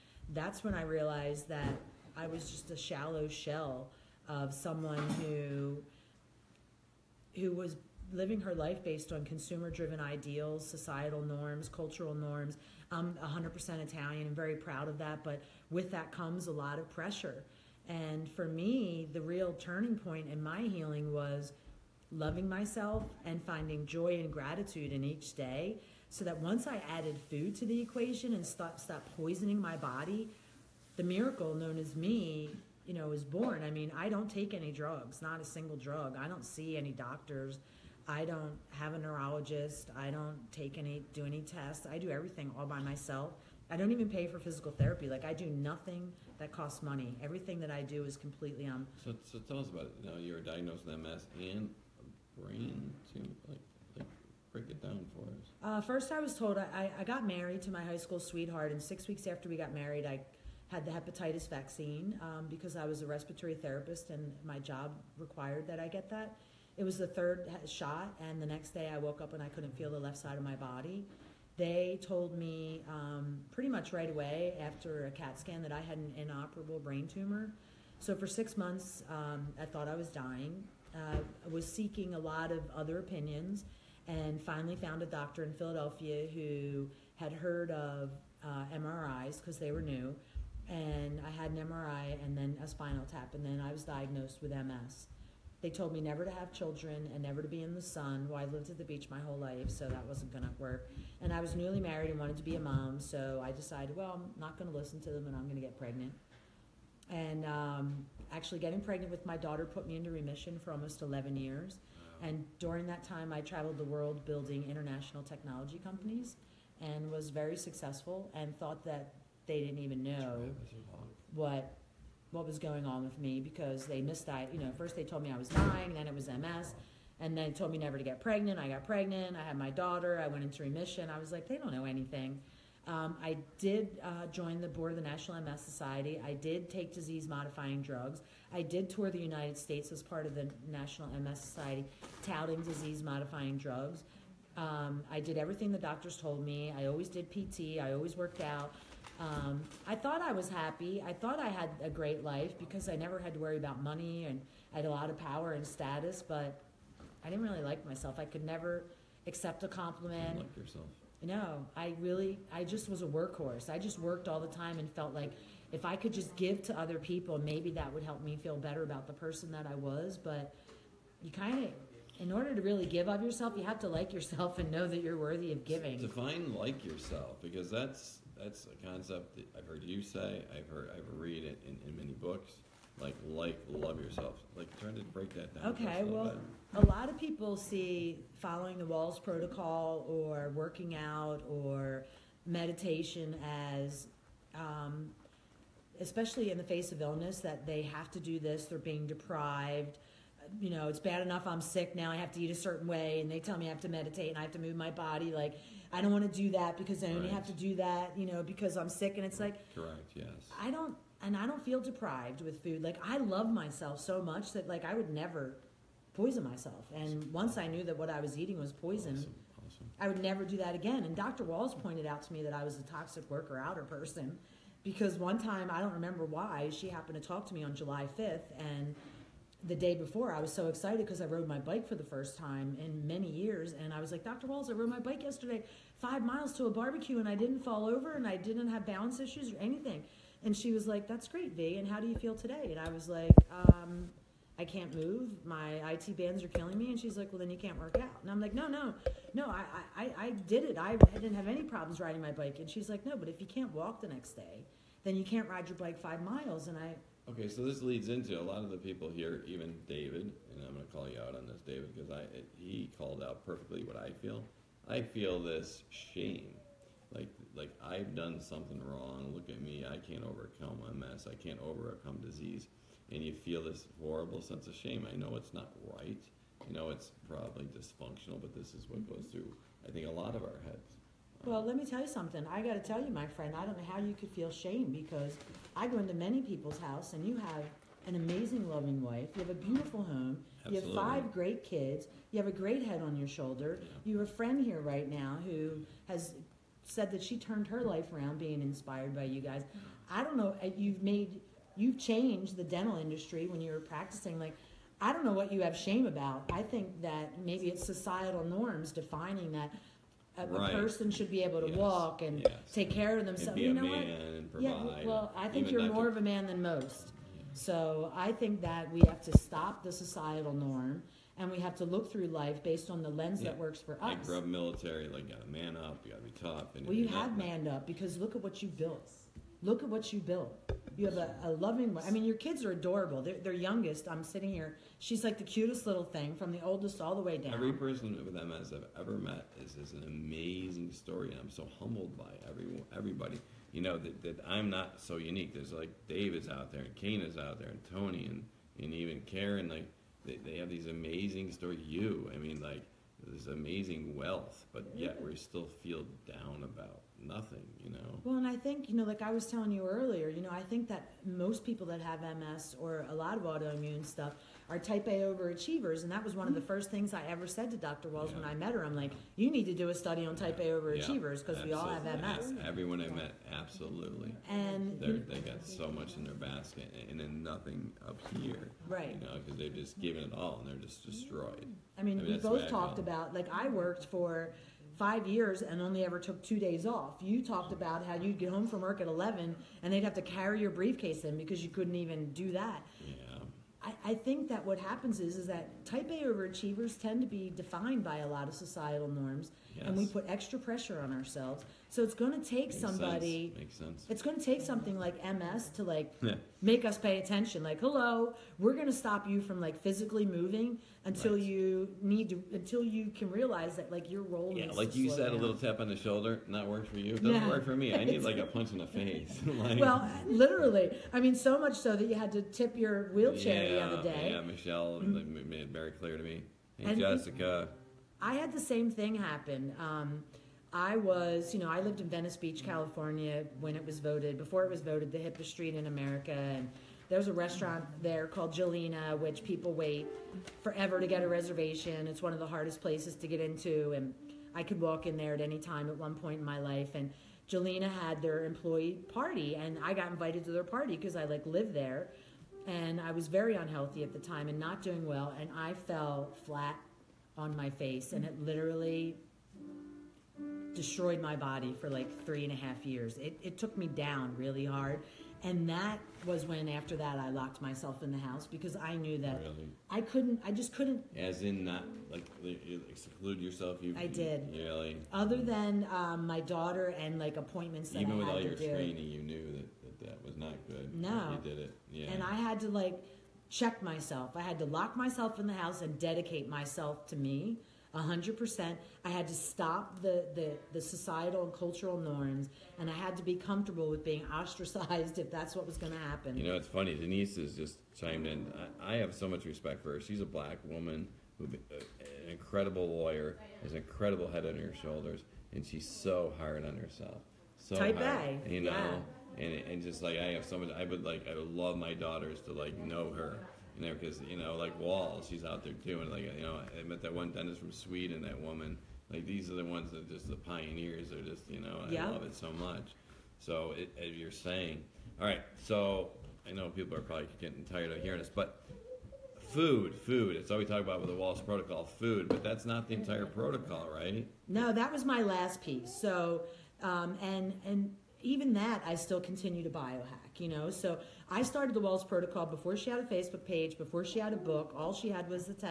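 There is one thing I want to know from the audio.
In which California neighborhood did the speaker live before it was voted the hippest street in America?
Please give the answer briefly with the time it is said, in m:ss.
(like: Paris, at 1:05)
Venice Beach, at 7:12.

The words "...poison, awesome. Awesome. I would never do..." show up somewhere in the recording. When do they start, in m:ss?
3:38.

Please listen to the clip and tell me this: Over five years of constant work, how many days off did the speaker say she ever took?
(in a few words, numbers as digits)
2.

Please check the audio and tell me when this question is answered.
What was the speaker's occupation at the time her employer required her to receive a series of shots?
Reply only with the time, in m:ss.
1:03.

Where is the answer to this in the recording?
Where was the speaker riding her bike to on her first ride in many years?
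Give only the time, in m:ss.
3:56.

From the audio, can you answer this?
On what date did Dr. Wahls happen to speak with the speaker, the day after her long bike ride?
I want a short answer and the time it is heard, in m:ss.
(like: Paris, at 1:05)
July 5th, at 3:47.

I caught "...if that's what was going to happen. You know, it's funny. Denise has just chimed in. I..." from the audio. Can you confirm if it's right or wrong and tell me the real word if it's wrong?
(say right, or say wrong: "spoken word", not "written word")
right.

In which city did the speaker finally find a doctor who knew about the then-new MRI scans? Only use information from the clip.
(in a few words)
Philadelphia.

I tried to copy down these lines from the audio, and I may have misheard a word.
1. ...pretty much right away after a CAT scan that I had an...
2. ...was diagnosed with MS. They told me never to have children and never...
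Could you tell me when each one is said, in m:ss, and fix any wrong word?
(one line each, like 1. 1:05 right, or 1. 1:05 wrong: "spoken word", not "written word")
1. 1:13 right
2. 1:33 right.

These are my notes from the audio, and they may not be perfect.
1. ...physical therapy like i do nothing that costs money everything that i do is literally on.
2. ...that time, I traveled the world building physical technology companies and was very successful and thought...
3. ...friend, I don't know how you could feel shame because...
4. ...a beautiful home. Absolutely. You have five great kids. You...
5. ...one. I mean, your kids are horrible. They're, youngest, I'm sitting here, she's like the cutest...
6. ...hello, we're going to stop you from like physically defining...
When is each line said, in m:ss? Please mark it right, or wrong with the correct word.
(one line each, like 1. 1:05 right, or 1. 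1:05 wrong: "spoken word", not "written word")
1. 0:44 wrong: "completely", not "literally"
2. 1:52 wrong: "international", not "physical"
3. 4:43 right
4. 4:49 right
5. 5:31 wrong: "adorable", not "horrible"
6. 6:47 wrong: "moving", not "defining".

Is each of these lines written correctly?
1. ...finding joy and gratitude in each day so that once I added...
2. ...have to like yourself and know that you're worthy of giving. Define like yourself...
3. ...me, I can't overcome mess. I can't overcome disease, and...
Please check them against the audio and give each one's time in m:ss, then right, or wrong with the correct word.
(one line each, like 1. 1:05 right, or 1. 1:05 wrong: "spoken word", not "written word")
1. 0:23 right
2. 2:53 right
3. 4:29 right.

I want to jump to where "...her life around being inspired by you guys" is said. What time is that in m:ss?
4:57.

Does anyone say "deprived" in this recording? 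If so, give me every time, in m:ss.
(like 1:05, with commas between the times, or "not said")
3:19, 3:31.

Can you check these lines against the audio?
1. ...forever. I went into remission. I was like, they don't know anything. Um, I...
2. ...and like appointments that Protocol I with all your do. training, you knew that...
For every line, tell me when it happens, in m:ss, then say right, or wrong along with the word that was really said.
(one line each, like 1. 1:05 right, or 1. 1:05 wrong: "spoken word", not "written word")
1. 2:09 wrong: "daughter", not "forever"
2. 7:56 wrong: "Even", not "Protocol".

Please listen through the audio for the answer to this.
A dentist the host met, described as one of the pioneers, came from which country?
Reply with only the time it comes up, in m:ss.
8:37.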